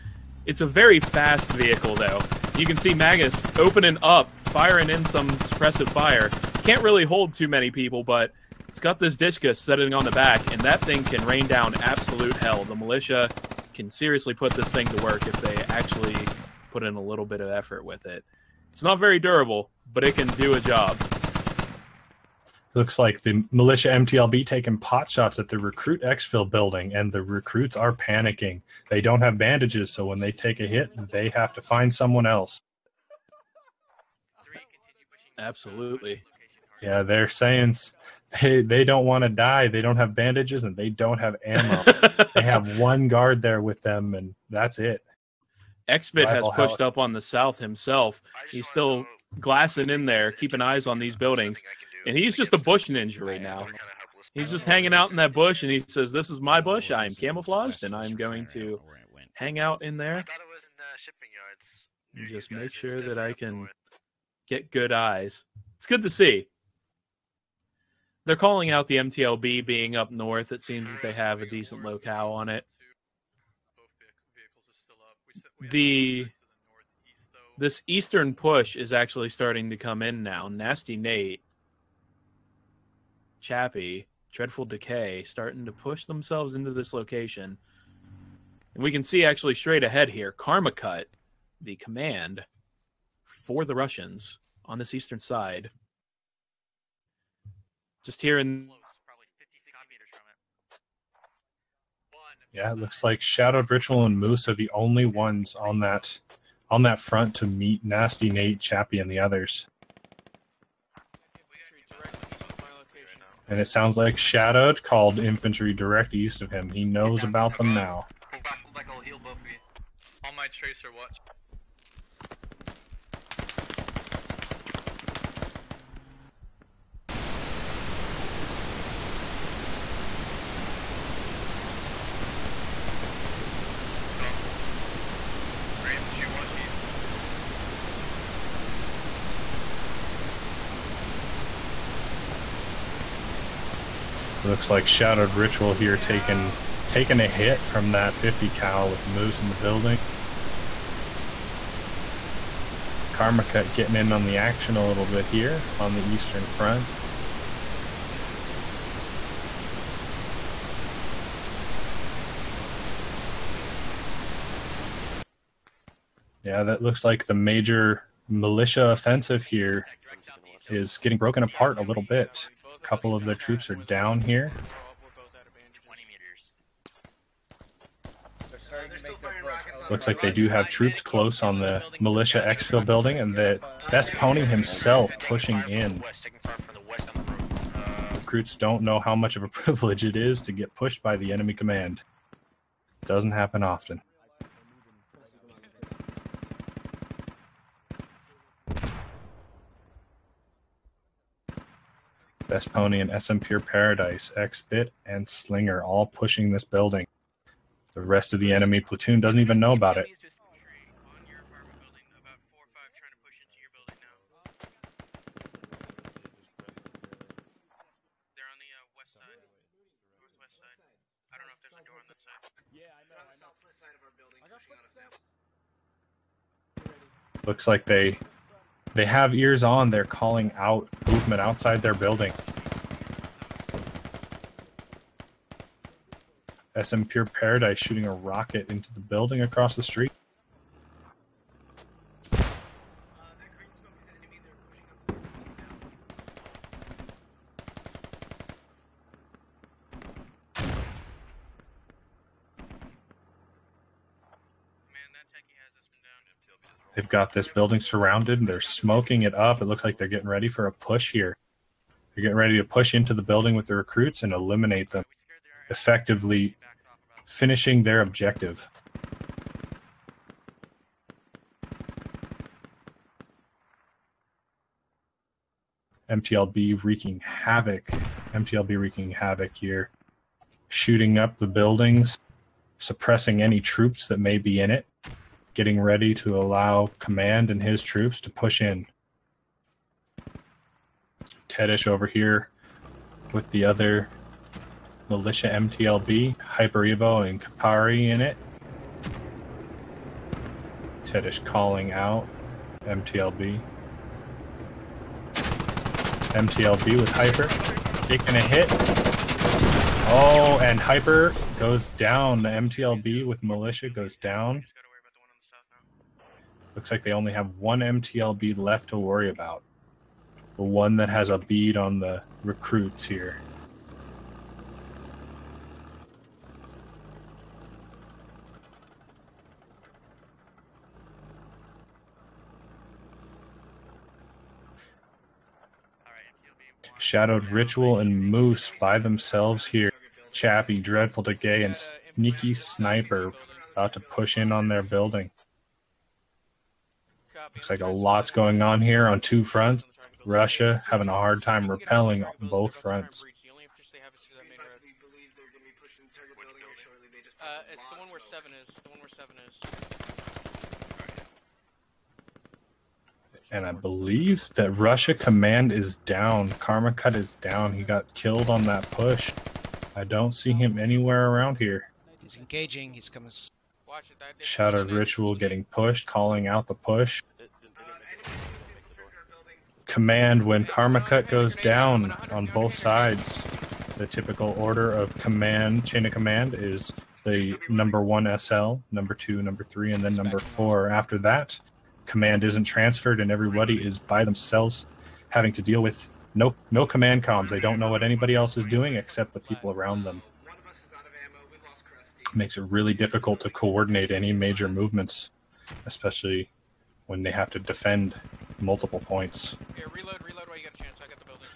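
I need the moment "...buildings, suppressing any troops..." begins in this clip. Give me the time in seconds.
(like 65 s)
281 s.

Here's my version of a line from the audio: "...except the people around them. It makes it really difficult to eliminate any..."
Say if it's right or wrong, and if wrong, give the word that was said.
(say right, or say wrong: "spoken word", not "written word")
wrong: "coordinate", not "eliminate".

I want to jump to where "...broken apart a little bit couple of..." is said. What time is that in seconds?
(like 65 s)
171 s.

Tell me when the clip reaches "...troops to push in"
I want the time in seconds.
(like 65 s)
287 s.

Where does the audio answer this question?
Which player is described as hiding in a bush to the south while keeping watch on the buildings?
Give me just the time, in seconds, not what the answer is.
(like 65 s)
45 s.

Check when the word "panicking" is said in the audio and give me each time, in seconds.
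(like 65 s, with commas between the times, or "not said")
27 s.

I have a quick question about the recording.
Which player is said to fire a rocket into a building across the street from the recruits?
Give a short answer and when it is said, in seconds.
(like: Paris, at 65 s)
SM Pure Paradise, at 236 s.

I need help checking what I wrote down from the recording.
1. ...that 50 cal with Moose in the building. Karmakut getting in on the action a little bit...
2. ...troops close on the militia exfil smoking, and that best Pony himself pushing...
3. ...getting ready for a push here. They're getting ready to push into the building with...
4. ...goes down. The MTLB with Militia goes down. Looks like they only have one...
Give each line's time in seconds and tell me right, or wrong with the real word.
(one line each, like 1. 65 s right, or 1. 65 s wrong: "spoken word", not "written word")
1. 147 s right
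2. 180 s wrong: "building", not "smoking"
3. 260 s right
4. 311 s right.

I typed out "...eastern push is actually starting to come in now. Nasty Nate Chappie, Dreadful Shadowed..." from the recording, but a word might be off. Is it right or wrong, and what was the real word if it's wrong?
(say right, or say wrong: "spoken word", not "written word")
wrong: "Decay", not "Shadowed".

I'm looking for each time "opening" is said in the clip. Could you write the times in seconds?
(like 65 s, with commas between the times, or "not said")
3 s.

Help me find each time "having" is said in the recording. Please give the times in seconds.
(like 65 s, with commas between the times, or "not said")
350 s, 395 s.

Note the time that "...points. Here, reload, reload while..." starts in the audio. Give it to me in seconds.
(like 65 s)
409 s.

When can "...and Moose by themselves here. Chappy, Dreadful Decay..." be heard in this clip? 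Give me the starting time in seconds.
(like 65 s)
338 s.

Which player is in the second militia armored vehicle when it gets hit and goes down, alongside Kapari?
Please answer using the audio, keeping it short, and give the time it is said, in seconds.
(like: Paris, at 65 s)
Hyper Evo, at 296 s.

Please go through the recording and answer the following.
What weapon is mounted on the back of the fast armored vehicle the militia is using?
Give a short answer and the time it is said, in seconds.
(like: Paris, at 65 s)
Dishka, at 9 s.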